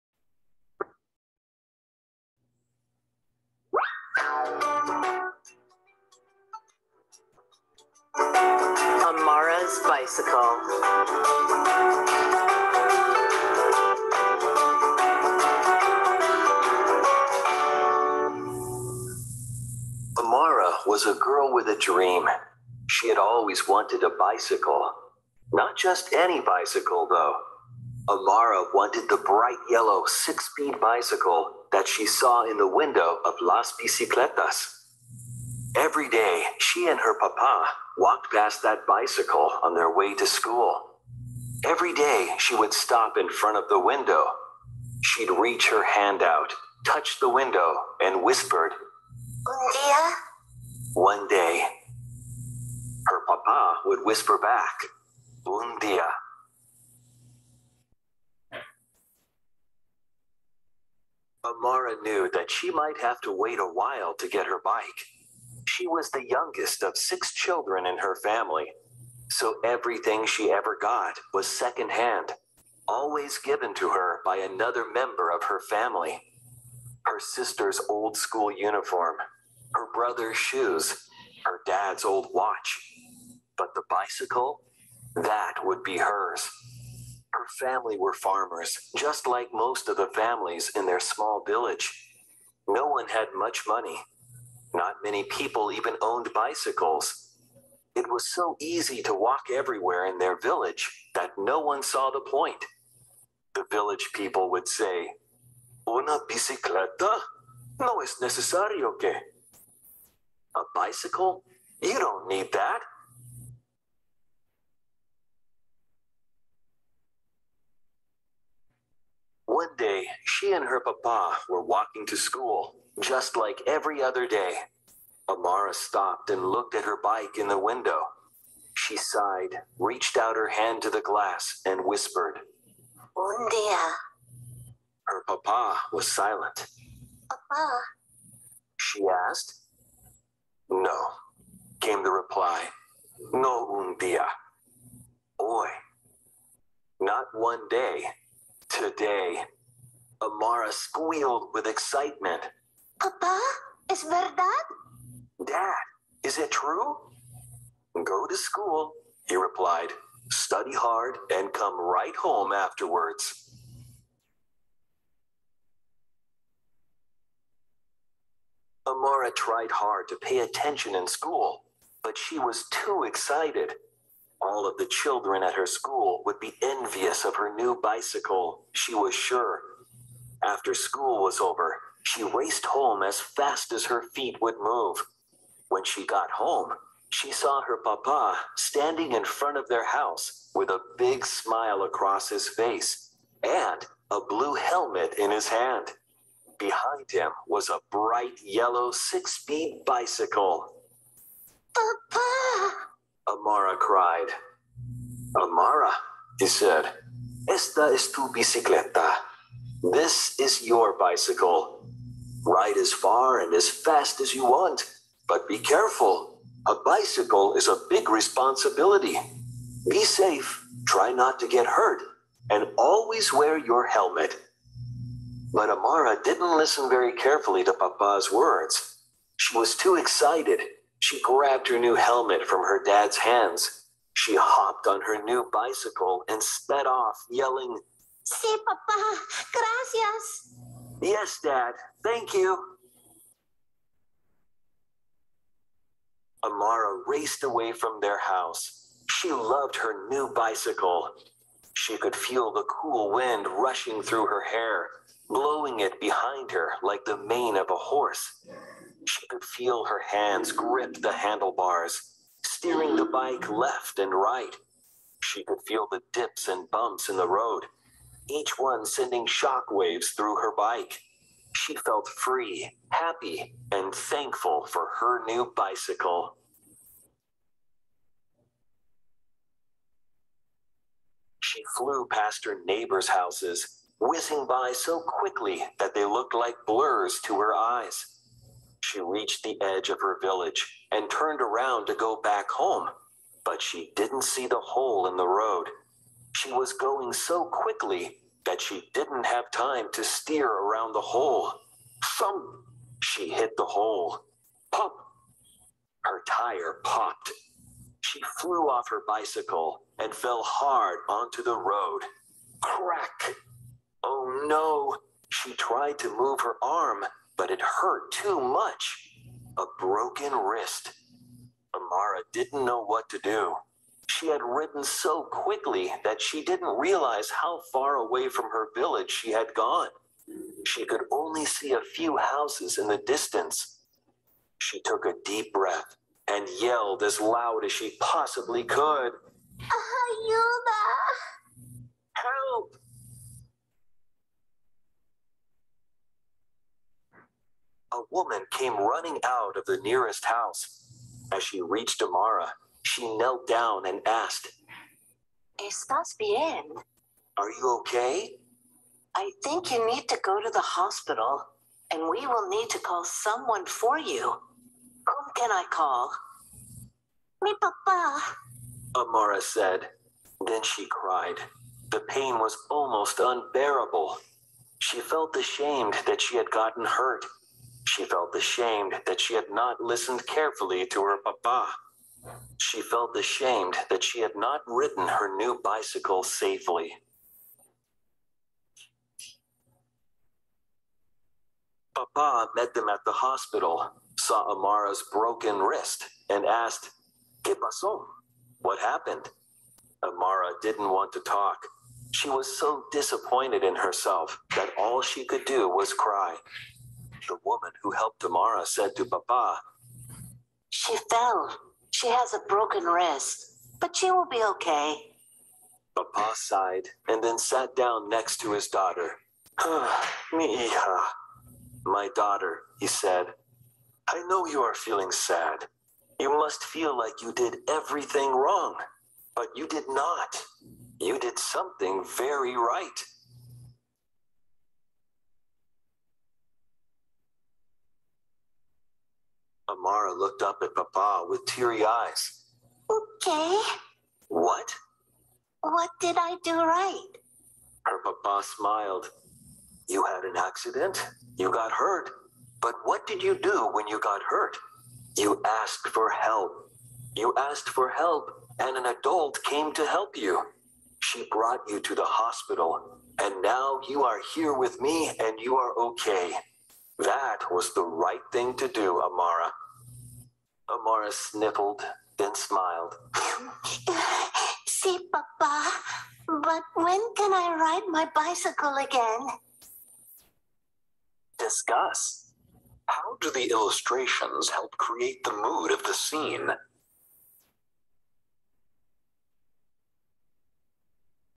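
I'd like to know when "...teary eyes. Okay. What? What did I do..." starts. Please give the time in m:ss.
7:21.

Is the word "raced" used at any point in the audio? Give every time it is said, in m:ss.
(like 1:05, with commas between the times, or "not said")
3:02, 4:07.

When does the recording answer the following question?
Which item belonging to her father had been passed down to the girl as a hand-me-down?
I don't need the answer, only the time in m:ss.
1:21.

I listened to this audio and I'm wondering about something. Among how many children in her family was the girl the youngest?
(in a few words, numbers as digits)
6.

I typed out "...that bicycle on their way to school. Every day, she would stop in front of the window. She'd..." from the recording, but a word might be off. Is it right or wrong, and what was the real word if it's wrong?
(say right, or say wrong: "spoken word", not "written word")
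right.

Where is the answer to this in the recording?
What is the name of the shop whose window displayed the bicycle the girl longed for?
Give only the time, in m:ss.
0:33.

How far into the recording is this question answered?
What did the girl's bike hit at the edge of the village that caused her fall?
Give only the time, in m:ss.
4:54.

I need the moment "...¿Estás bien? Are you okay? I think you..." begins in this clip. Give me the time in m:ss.
5:55.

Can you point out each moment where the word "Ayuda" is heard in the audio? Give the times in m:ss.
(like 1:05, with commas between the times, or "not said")
5:39.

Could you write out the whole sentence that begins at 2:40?
Study hard and come right home afterwards.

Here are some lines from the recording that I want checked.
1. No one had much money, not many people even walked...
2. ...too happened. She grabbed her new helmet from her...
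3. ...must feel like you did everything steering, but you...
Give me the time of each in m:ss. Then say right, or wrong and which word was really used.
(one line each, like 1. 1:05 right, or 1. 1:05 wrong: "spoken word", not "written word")
1. 1:32 wrong: "owned", not "walked"
2. 3:49 wrong: "excited", not "happened"
3. 7:06 wrong: "wrong", not "steering".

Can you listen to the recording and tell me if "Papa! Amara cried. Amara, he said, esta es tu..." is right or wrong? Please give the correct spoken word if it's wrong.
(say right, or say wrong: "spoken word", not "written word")
right.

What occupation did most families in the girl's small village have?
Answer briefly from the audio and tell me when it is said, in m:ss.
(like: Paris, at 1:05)
farmers, at 1:28.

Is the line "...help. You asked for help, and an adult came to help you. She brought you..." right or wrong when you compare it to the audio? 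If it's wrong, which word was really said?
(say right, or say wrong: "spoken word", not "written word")
right.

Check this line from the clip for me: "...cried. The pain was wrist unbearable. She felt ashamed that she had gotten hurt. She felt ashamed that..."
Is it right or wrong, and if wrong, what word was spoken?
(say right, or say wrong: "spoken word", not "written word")
wrong: "almost", not "wrist".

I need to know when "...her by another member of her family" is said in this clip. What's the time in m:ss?
1:13.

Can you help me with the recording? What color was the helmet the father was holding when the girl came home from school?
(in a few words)
blue.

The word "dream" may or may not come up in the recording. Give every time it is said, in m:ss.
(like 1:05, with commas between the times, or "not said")
0:21.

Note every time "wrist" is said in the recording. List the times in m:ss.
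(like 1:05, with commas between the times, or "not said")
5:20, 6:35, 6:52.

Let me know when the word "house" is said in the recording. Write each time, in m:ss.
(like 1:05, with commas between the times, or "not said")
3:09, 4:08, 4:43, 5:32, 5:50.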